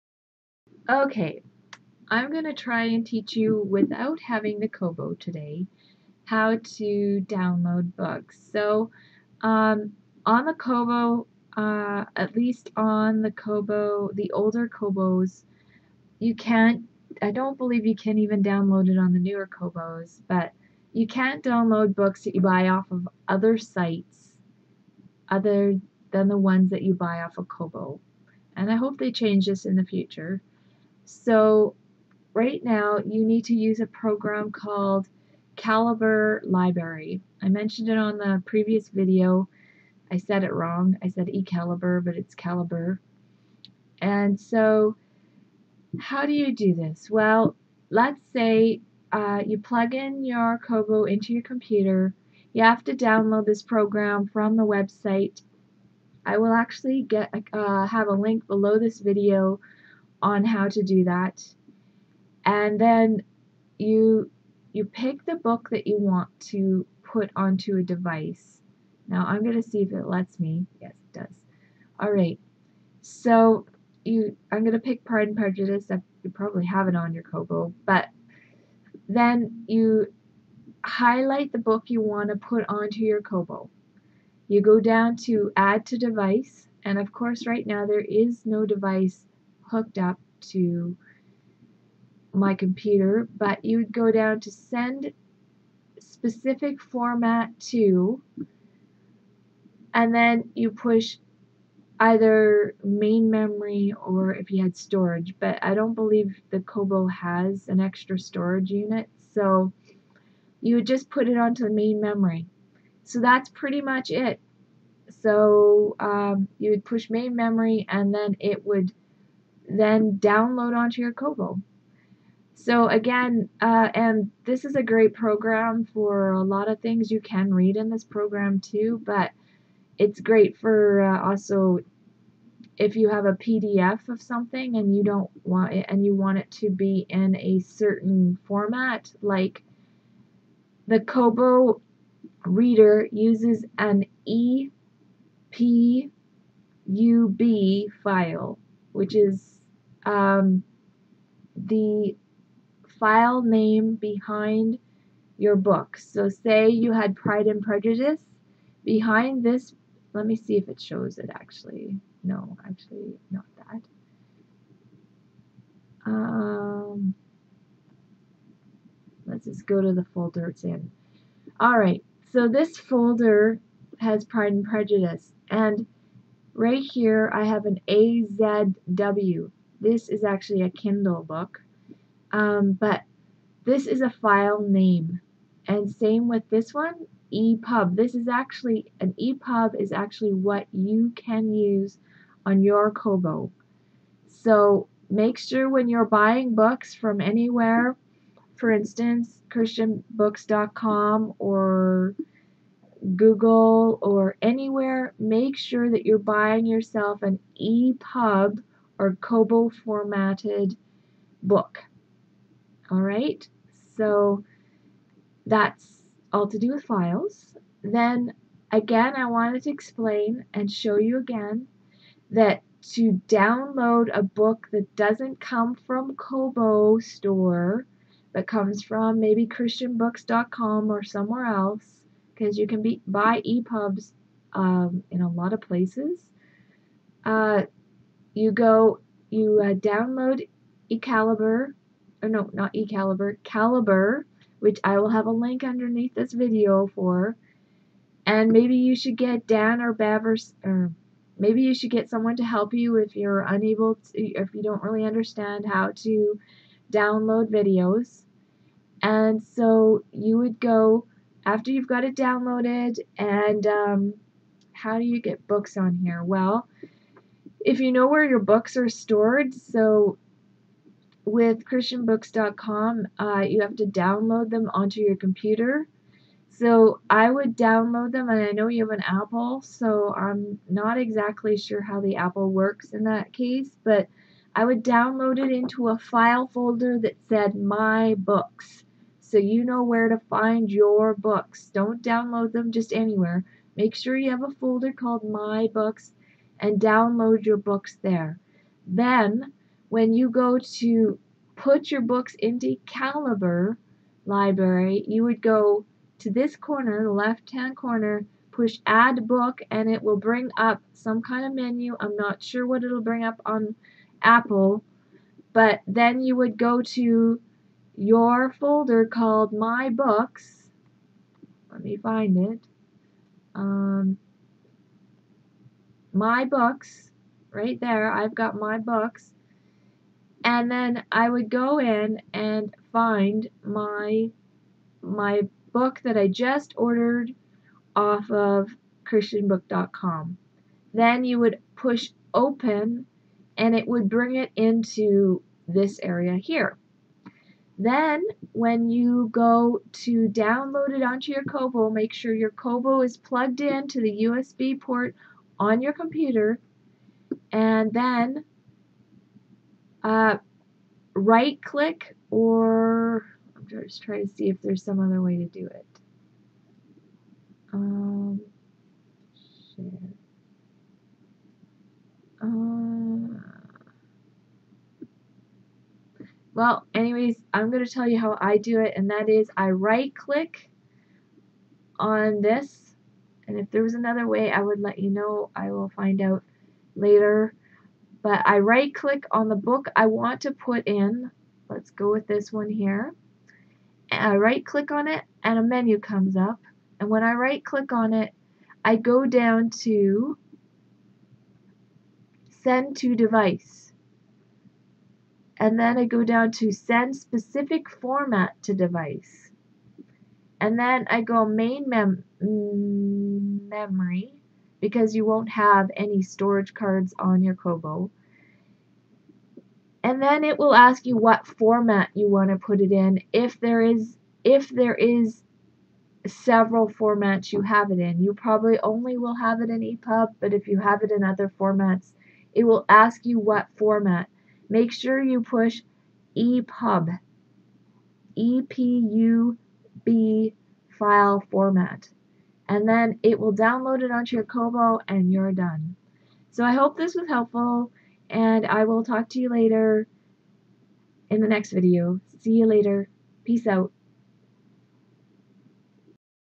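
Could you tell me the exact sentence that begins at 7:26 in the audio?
So I hope this was helpful and I will talk to you later in the next video.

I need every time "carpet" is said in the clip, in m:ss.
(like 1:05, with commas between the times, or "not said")
not said.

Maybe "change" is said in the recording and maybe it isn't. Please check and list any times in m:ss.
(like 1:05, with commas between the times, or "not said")
0:29.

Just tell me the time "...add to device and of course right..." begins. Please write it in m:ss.
1:25.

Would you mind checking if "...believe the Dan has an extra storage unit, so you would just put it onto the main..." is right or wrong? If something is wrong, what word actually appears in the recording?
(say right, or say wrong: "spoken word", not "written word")
wrong: "Kobo", not "Dan".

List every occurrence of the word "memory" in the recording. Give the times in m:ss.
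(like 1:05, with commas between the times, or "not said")
1:43, 1:52, 1:57, 6:52.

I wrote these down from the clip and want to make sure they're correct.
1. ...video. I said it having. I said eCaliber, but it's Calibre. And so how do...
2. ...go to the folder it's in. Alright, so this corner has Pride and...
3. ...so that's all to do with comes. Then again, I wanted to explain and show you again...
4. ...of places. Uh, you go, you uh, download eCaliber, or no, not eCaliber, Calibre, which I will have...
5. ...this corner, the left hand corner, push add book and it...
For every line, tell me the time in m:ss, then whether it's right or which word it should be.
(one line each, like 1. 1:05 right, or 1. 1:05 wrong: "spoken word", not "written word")
1. 0:38 wrong: "wrong", not "having"
2. 2:49 wrong: "folder", not "corner"
3. 3:33 wrong: "files", not "comes"
4. 3:55 right
5. 5:06 right.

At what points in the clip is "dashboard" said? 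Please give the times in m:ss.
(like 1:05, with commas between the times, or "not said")
not said.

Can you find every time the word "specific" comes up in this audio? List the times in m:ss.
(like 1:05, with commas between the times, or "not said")
1:35, 6:47.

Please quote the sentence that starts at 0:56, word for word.
I will actually get uh, have a link below this video on how to do that.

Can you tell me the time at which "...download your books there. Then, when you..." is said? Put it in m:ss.
4:56.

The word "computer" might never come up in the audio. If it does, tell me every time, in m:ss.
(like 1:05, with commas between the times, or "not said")
0:51, 1:32, 4:35, 5:55.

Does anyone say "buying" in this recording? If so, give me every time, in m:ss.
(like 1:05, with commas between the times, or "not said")
3:16, 3:26.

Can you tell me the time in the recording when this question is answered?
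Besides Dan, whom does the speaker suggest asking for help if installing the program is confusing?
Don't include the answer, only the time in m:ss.
4:09.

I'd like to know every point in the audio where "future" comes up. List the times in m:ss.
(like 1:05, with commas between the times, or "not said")
0:29.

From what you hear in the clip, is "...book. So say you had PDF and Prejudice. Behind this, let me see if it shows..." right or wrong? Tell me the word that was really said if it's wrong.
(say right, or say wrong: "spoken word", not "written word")
wrong: "Pride", not "PDF".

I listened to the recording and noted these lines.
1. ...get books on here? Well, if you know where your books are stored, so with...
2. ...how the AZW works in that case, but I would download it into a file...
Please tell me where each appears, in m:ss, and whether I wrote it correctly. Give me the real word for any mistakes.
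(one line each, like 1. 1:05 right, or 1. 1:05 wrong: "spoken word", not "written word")
1. 4:25 right
2. 4:41 wrong: "Apple", not "AZW".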